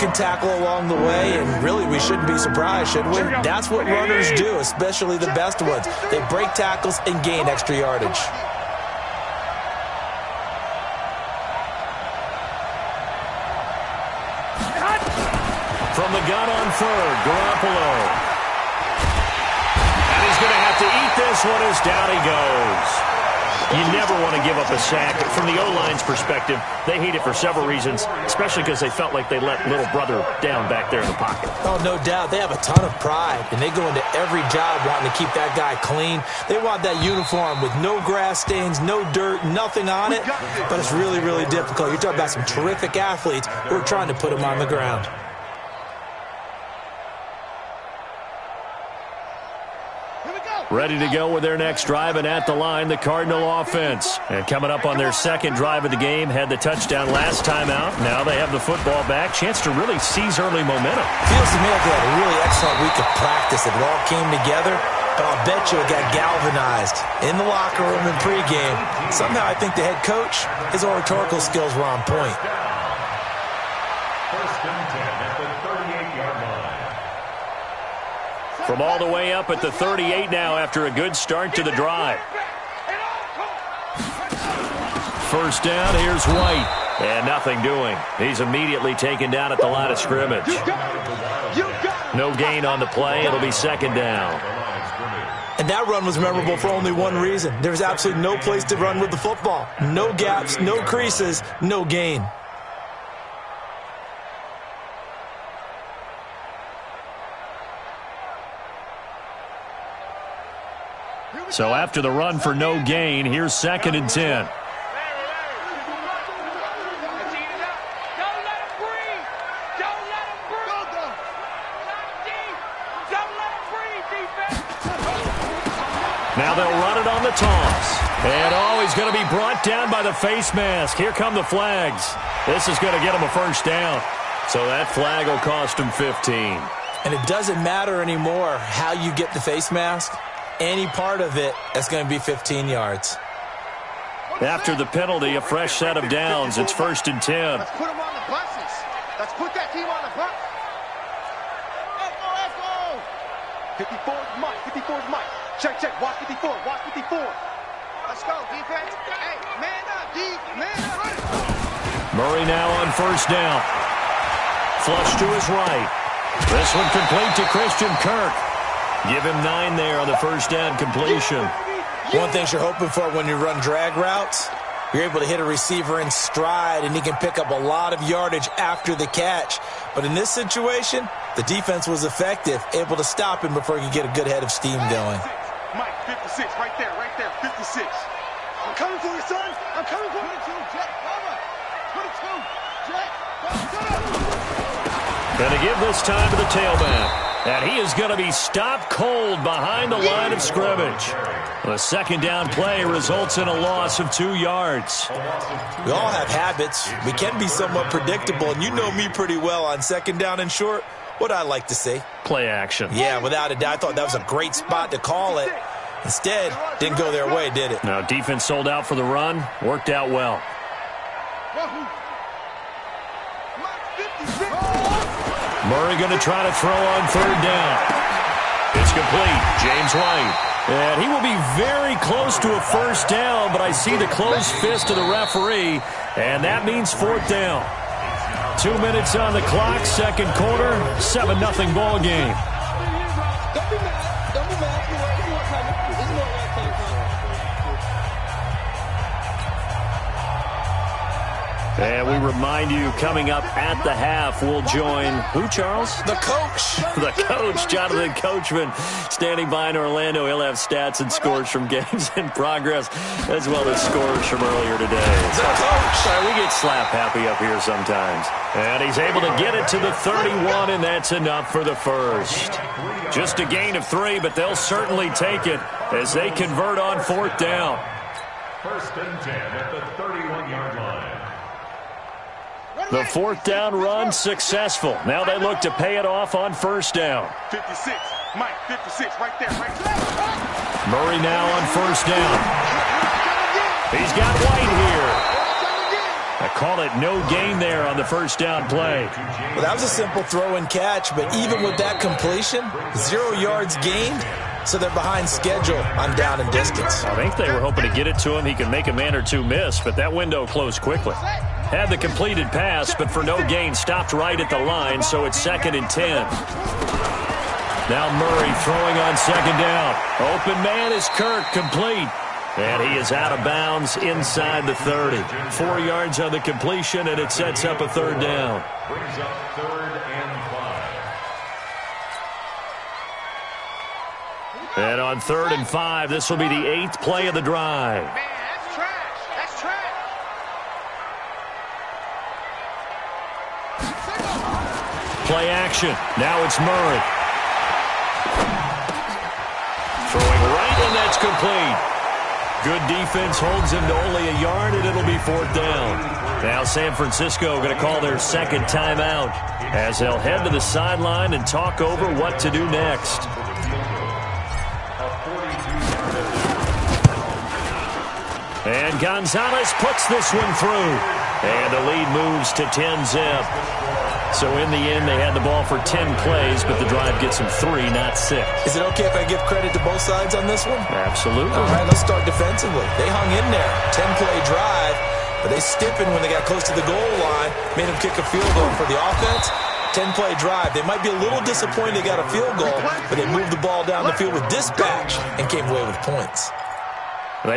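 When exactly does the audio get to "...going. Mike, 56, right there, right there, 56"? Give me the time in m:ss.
3:04.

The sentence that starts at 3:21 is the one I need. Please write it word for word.
The second down play results in a loss of two yards.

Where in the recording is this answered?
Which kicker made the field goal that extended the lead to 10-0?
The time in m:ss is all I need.
6:09.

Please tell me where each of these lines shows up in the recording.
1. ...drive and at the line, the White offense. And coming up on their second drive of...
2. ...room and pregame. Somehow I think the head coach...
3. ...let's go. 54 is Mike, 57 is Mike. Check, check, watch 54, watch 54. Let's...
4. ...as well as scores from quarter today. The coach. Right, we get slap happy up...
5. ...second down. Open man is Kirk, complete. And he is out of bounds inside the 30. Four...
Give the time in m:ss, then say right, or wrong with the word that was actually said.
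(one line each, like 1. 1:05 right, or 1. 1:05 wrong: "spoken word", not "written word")
1. 0:51 wrong: "Cardinal", not "White"
2. 1:07 right
3. 2:32 wrong: "54", not "57"
4. 4:23 wrong: "earlier", not "quarter"
5. 5:19 right.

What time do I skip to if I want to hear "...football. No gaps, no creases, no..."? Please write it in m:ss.
1:39.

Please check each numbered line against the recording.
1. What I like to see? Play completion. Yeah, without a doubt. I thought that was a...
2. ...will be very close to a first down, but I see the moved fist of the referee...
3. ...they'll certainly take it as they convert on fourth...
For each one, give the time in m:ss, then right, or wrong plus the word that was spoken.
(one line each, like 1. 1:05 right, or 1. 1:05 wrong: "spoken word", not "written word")
1. 3:31 wrong: "action", not "completion"
2. 3:51 wrong: "closed", not "moved"
3. 4:34 right.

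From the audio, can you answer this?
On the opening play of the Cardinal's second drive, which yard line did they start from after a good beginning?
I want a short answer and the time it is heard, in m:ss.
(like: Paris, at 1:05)
38, at 1:19.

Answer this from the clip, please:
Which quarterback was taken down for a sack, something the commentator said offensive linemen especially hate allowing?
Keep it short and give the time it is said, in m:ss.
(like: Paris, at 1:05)
Garoppolo, at 0:17.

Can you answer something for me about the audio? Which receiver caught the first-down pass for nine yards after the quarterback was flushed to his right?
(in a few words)
Christian Kirk.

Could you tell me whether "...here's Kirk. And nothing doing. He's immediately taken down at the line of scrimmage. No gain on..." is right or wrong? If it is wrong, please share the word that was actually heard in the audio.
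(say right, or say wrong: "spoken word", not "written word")
wrong: "White", not "Kirk".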